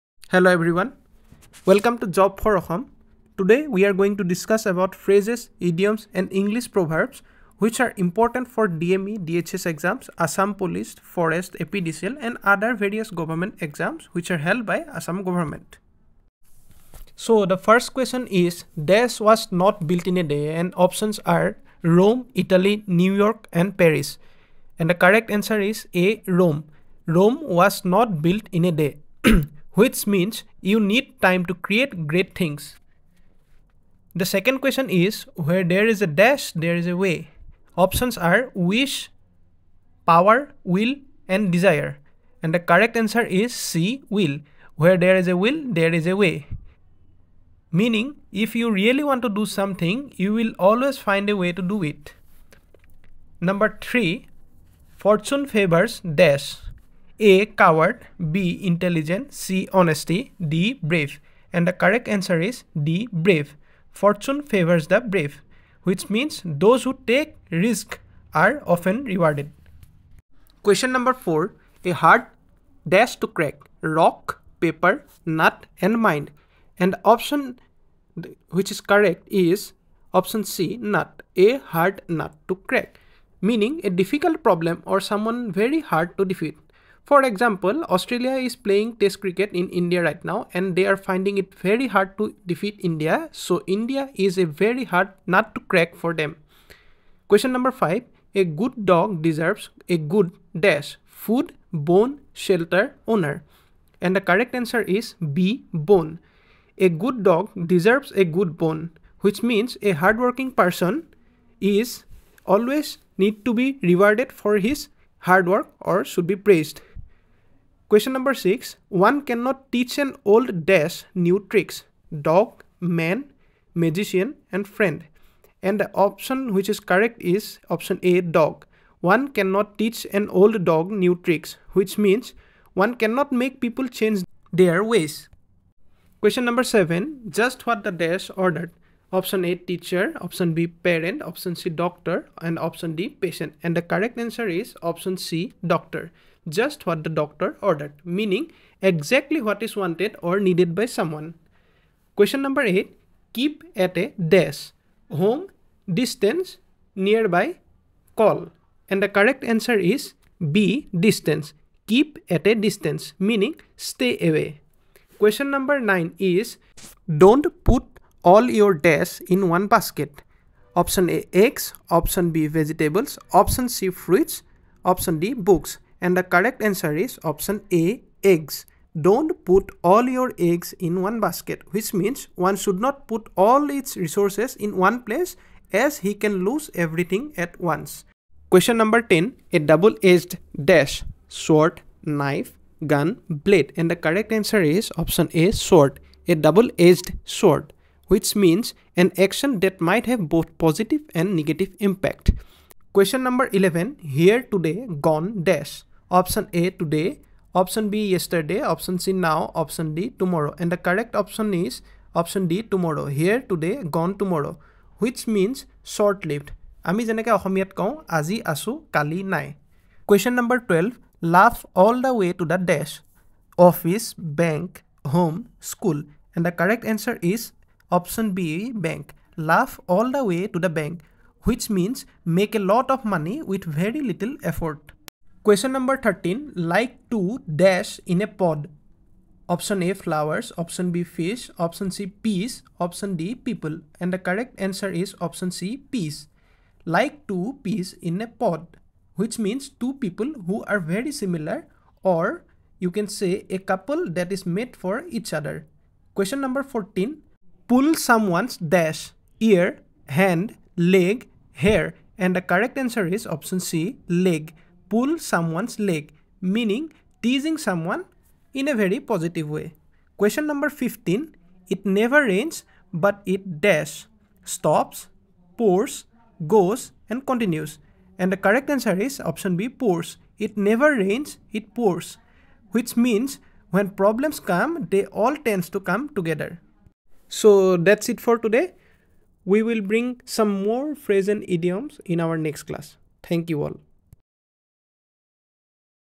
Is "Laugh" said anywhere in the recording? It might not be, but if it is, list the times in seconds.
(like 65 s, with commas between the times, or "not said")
221 s, 229 s.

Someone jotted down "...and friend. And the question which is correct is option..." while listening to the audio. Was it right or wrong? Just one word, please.
wrong.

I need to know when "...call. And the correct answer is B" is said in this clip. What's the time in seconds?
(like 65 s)
158 s.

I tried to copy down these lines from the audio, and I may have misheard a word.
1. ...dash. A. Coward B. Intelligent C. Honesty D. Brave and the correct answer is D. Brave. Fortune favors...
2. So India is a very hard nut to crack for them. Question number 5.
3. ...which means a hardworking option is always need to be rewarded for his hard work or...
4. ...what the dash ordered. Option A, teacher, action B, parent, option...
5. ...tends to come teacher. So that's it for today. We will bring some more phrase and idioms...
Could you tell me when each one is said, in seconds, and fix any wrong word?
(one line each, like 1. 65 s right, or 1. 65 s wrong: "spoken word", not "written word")
1. 56 s right
2. 93 s right
3. 109 s wrong: "person", not "option"
4. 137 s wrong: "option", not "action"
5. 285 s wrong: "together", not "teacher".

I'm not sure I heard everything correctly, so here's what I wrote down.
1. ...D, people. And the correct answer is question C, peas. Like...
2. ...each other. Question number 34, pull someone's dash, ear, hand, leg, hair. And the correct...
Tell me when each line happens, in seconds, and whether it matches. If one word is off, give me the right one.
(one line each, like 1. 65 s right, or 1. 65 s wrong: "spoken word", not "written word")
1. 243 s wrong: "option", not "question"
2. 255 s wrong: "14", not "34".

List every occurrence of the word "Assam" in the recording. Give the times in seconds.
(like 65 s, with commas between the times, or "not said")
2 s, 10 s, 15 s.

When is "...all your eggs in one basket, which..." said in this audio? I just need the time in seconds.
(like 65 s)
179 s.